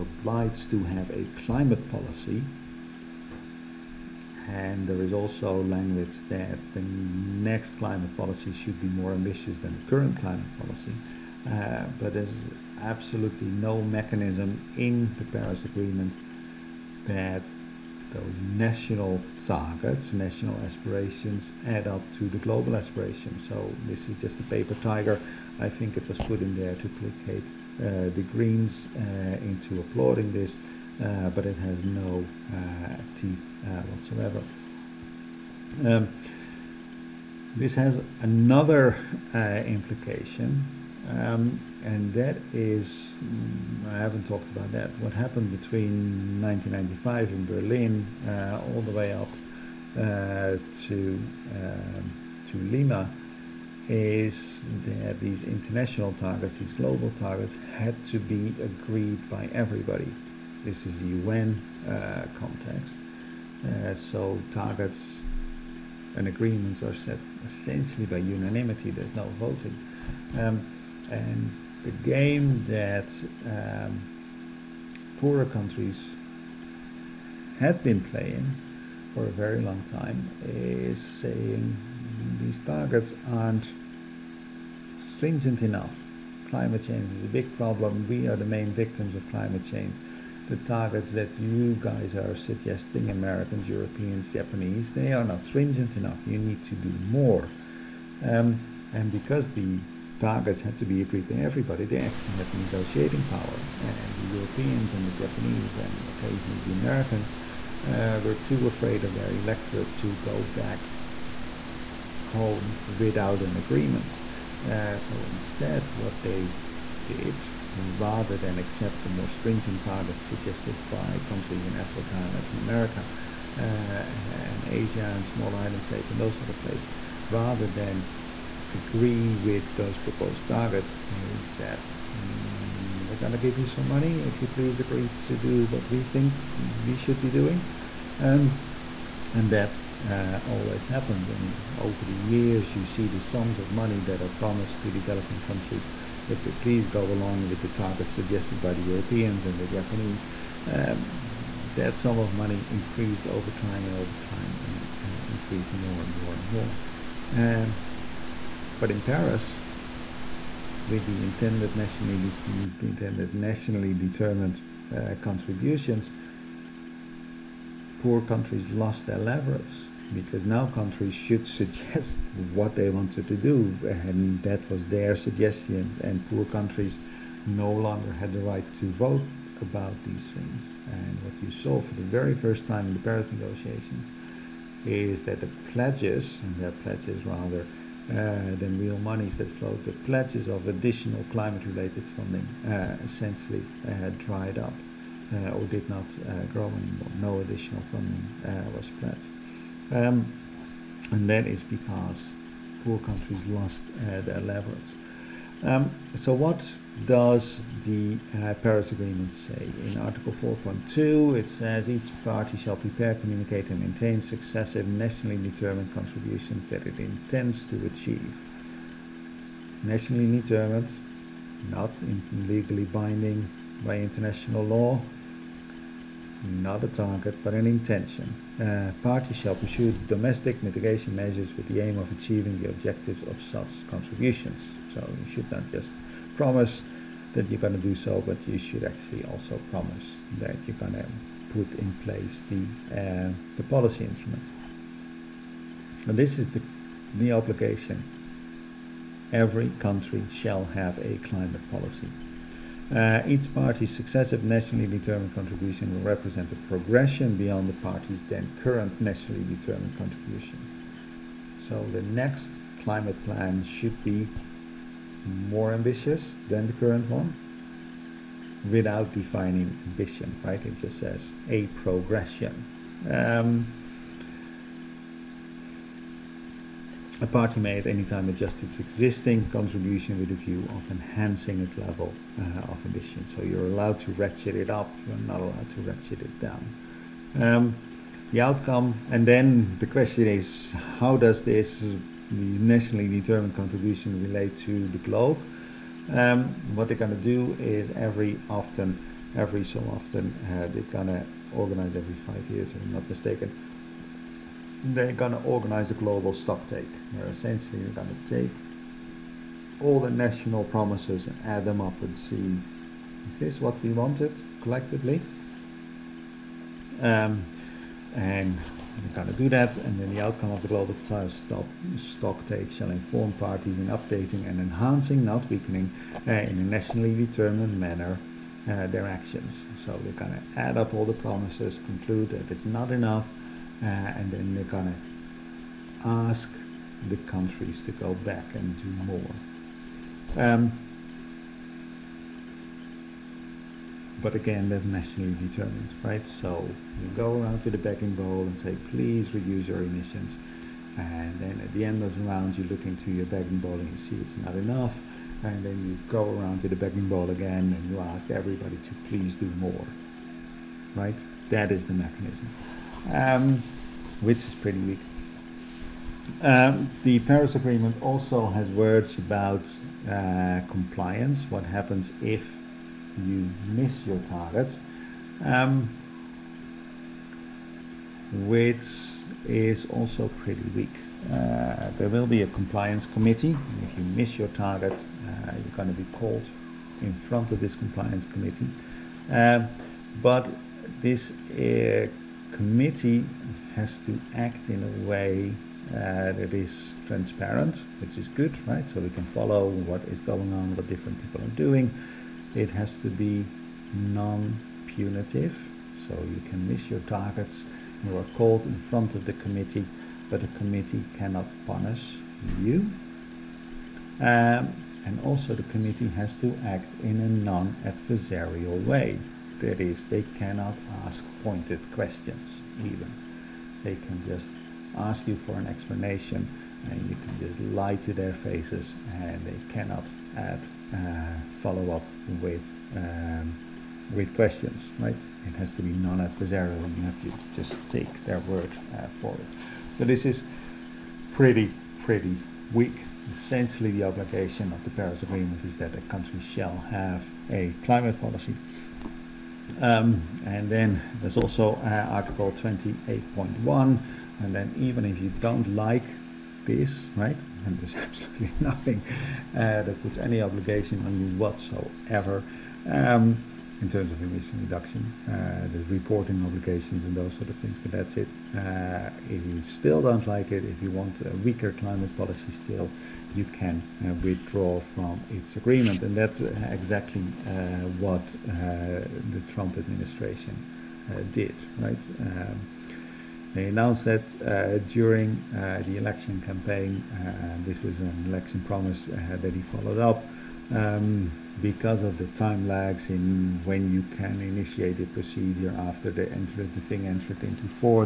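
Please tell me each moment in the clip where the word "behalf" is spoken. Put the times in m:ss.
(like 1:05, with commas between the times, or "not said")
not said.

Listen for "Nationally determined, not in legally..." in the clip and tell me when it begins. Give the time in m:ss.
3:39.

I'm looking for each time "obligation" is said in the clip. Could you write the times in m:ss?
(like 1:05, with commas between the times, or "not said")
4:07, 7:24, 7:40, 7:46.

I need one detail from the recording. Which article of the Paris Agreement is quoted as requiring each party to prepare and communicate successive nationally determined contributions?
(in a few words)
Article 4.2.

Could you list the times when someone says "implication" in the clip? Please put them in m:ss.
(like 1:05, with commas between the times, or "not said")
0:39.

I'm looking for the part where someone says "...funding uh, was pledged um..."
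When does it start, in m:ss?
3:17.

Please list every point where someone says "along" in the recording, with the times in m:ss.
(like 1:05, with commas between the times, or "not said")
2:27.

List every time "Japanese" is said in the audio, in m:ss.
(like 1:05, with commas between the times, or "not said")
1:34, 1:45, 2:29.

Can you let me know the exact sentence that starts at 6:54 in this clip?
Um, and also the committee has to act in a non-adversarial way there is they cannot ask pointed questions even.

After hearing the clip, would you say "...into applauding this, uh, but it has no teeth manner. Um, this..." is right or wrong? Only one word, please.
wrong.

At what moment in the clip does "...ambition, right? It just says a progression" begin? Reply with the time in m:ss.
4:29.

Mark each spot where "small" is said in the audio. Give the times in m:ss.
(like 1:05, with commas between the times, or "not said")
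2:05.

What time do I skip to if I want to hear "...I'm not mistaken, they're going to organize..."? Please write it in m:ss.
5:02.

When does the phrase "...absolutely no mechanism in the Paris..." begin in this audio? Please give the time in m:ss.
0:12.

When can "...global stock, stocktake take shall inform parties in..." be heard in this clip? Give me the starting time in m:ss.
5:20.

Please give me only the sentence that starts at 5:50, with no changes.
And then at the end of the round, you look into your begging bowl and you see it's not enough.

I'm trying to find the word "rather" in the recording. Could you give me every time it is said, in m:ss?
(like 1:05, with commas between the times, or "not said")
1:57, 2:07, 3:07.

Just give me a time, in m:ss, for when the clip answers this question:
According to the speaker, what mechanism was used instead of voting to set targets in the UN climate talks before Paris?
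1:08.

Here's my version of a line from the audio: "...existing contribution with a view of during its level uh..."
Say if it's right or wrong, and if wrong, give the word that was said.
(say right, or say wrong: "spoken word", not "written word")
wrong: "enhancing", not "during".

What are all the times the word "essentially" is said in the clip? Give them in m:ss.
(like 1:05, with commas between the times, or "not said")
1:07, 3:13, 5:07, 7:23.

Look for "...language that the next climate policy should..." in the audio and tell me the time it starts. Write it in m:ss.
0:05.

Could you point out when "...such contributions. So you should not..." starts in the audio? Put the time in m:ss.
3:53.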